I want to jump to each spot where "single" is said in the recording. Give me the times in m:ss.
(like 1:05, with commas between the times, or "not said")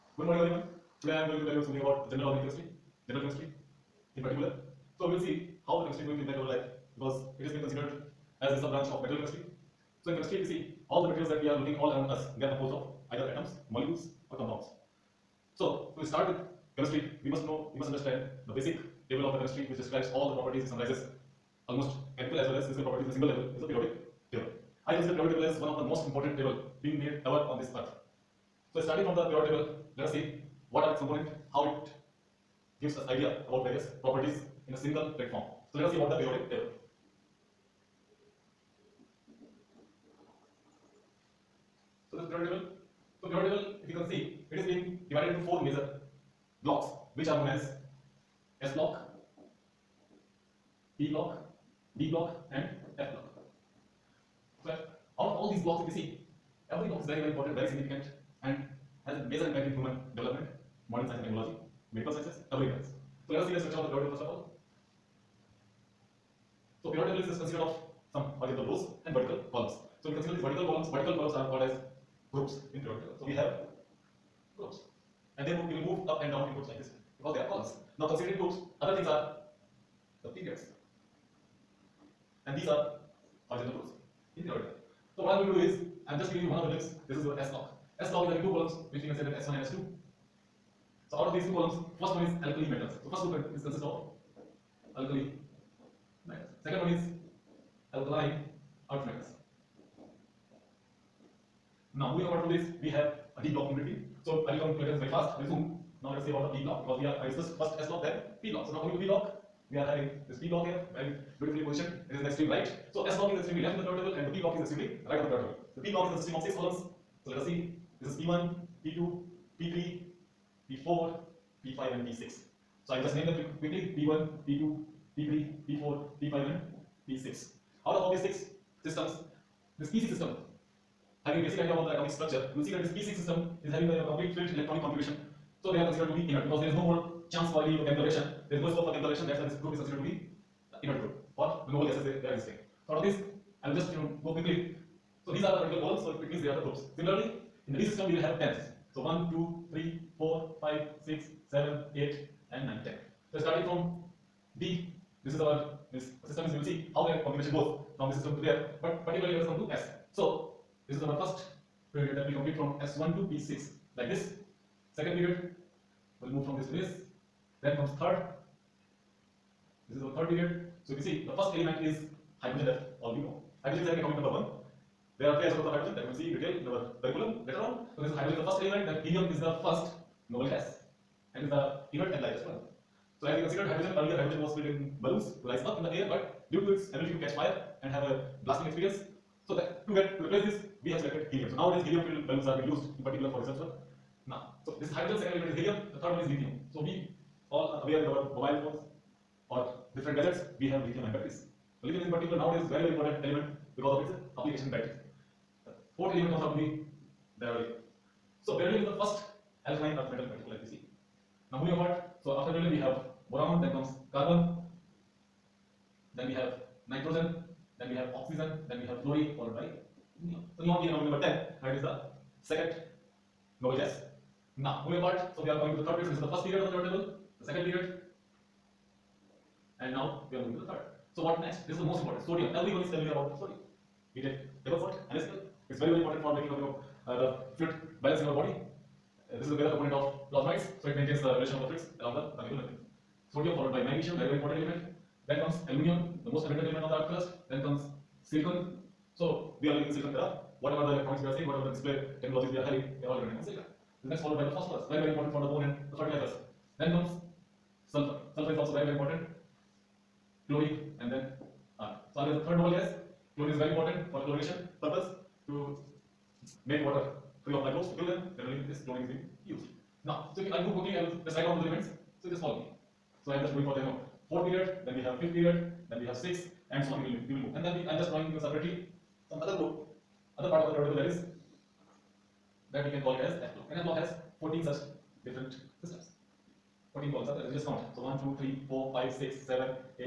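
0:23, 0:34.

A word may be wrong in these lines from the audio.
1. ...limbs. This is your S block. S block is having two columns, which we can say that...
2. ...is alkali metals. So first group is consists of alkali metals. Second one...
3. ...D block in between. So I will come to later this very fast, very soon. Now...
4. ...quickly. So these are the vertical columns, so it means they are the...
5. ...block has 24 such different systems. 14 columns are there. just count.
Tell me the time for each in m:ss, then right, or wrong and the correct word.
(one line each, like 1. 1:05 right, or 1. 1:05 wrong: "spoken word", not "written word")
1. 1:26 right
2. 1:32 right
3. 1:43 right
4. 2:24 right
5. 4:43 wrong: "14", not "24".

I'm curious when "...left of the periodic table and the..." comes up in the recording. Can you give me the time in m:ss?
1:53.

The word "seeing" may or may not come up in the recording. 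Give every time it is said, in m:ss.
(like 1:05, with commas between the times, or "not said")
4:11.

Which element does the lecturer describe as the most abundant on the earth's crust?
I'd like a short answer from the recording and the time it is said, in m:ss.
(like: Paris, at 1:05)
Aluminium, at 4:05.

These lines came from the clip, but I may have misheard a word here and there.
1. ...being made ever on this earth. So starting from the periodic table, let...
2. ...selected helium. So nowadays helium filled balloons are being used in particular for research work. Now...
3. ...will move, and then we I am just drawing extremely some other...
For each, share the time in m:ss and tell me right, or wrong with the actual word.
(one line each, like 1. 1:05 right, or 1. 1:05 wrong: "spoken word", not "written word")
1. 0:26 right
2. 3:10 right
3. 4:37 wrong: "separately", not "extremely".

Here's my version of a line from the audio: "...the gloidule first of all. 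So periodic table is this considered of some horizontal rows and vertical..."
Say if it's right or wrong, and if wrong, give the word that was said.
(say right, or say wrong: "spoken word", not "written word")
right.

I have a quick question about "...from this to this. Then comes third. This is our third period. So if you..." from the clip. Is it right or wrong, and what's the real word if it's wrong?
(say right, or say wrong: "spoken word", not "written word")
right.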